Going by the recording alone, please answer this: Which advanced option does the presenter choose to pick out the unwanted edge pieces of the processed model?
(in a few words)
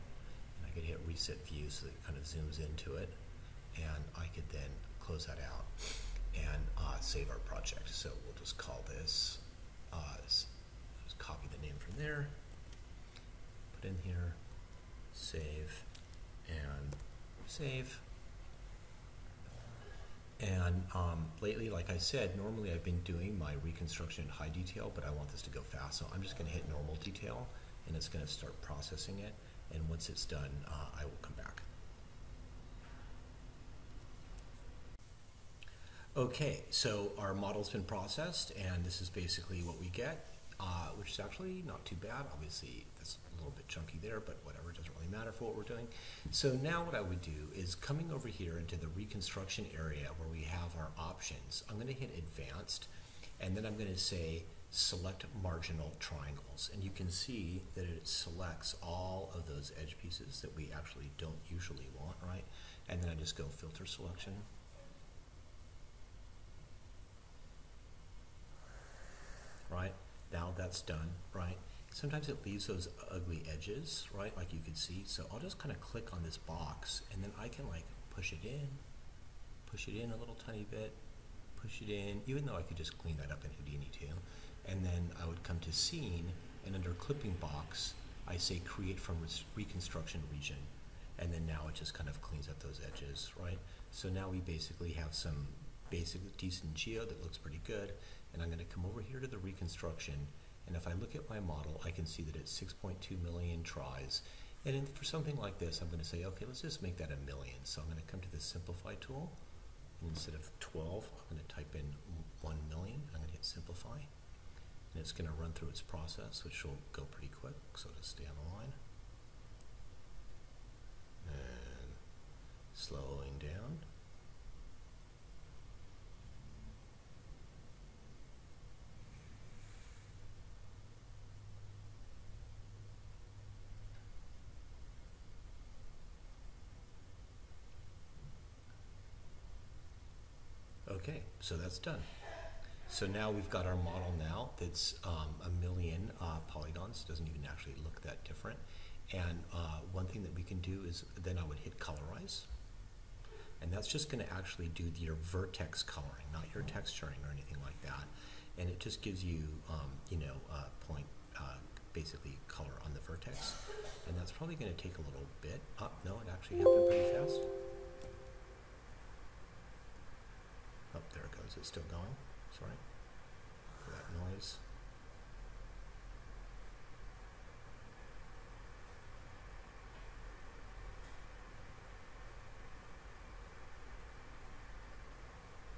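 select marginal triangles.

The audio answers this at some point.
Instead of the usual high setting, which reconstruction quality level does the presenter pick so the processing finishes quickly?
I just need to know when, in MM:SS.
00:26.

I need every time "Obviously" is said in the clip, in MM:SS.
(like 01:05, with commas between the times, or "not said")
00:42.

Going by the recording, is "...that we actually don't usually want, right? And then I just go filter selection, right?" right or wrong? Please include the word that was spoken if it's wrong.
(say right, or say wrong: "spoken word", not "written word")
right.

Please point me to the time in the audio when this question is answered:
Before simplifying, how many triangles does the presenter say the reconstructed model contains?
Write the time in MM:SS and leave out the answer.
01:42.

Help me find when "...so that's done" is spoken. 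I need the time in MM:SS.
02:21.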